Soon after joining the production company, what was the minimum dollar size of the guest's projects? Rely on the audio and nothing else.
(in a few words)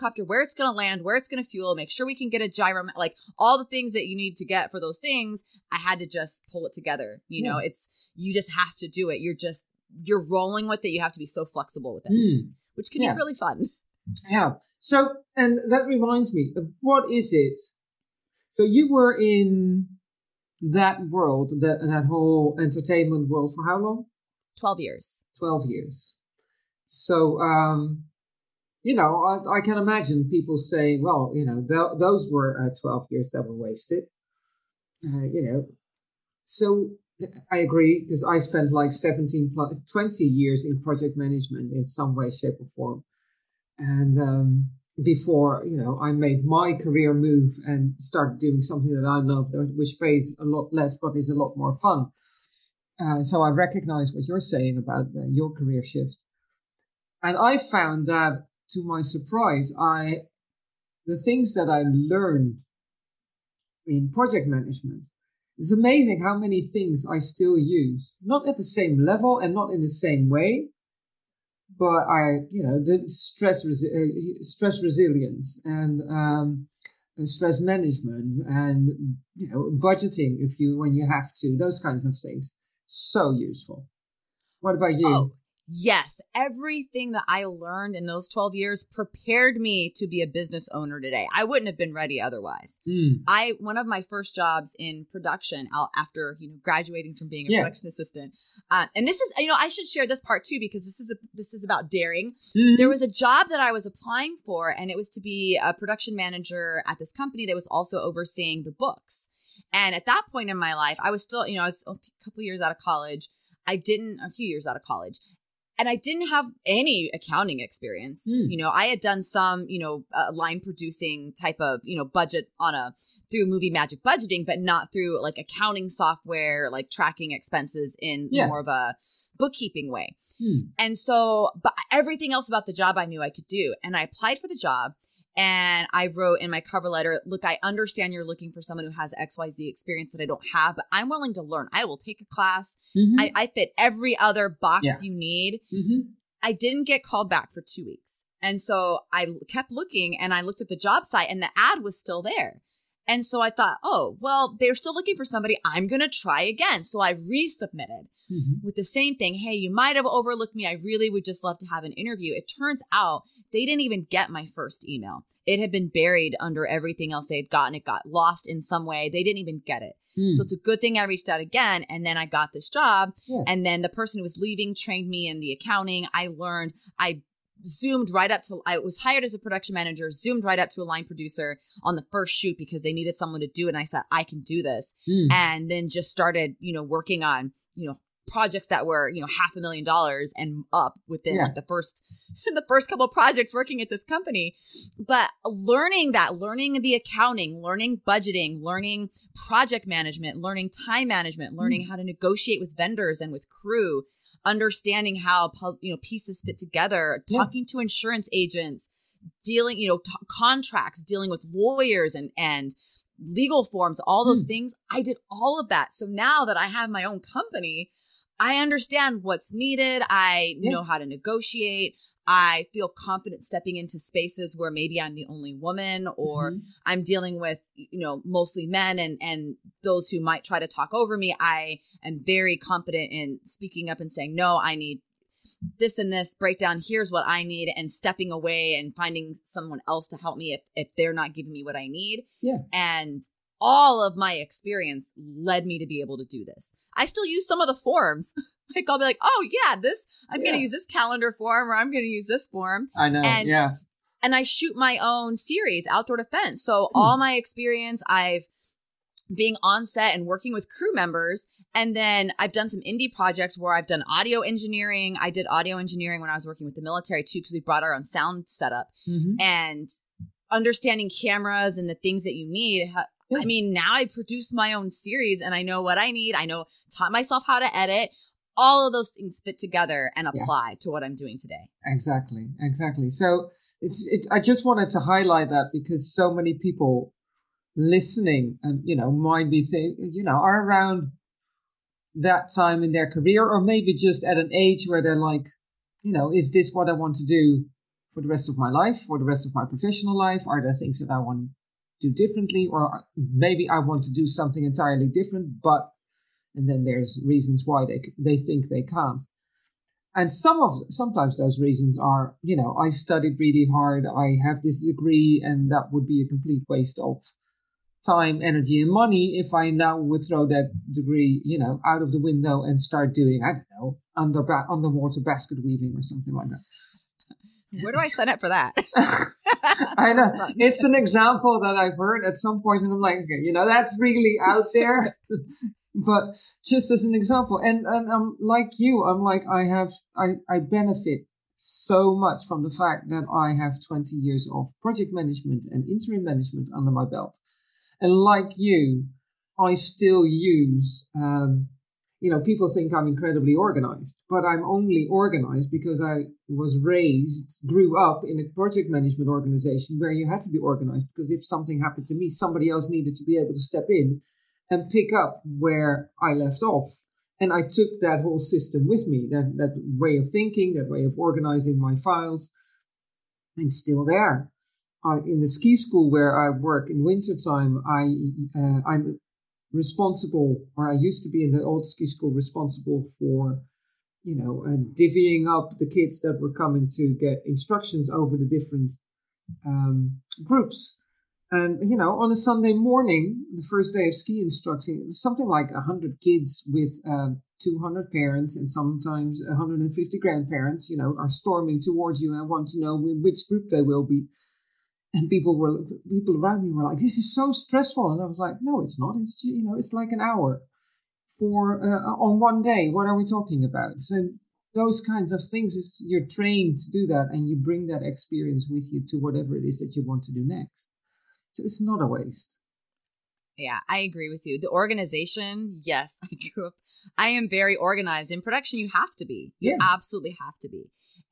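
half a million dollars.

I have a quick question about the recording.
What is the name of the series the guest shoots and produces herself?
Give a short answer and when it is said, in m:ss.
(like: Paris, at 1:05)
Outdoor Defense, at 4:15.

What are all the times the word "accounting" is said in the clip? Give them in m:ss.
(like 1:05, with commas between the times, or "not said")
1:57, 2:05, 2:55, 3:16.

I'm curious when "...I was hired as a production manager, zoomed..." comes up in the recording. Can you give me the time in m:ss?
2:58.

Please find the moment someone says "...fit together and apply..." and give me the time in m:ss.
4:39.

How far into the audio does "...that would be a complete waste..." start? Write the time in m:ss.
5:15.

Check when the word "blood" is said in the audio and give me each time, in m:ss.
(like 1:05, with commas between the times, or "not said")
not said.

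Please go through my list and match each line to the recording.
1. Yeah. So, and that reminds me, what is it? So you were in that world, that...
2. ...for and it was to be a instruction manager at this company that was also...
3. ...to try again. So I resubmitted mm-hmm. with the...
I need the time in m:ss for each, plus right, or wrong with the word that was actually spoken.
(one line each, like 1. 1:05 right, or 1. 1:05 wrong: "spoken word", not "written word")
1. 0:14 right
2. 1:44 wrong: "production", not "instruction"
3. 2:35 right.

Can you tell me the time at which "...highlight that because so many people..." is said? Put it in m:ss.
4:44.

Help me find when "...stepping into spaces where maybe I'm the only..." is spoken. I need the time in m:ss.
3:43.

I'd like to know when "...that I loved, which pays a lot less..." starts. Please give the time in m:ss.
0:48.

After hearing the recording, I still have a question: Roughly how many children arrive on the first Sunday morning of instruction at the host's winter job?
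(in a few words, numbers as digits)
100.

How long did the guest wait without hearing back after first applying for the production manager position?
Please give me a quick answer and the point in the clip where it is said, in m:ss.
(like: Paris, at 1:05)
2 weeks, at 2:27.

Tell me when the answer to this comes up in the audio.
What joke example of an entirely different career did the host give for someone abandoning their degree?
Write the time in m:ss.
5:24.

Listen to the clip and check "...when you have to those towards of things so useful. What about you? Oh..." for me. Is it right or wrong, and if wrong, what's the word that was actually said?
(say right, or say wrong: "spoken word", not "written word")
wrong: "kinds", not "towards".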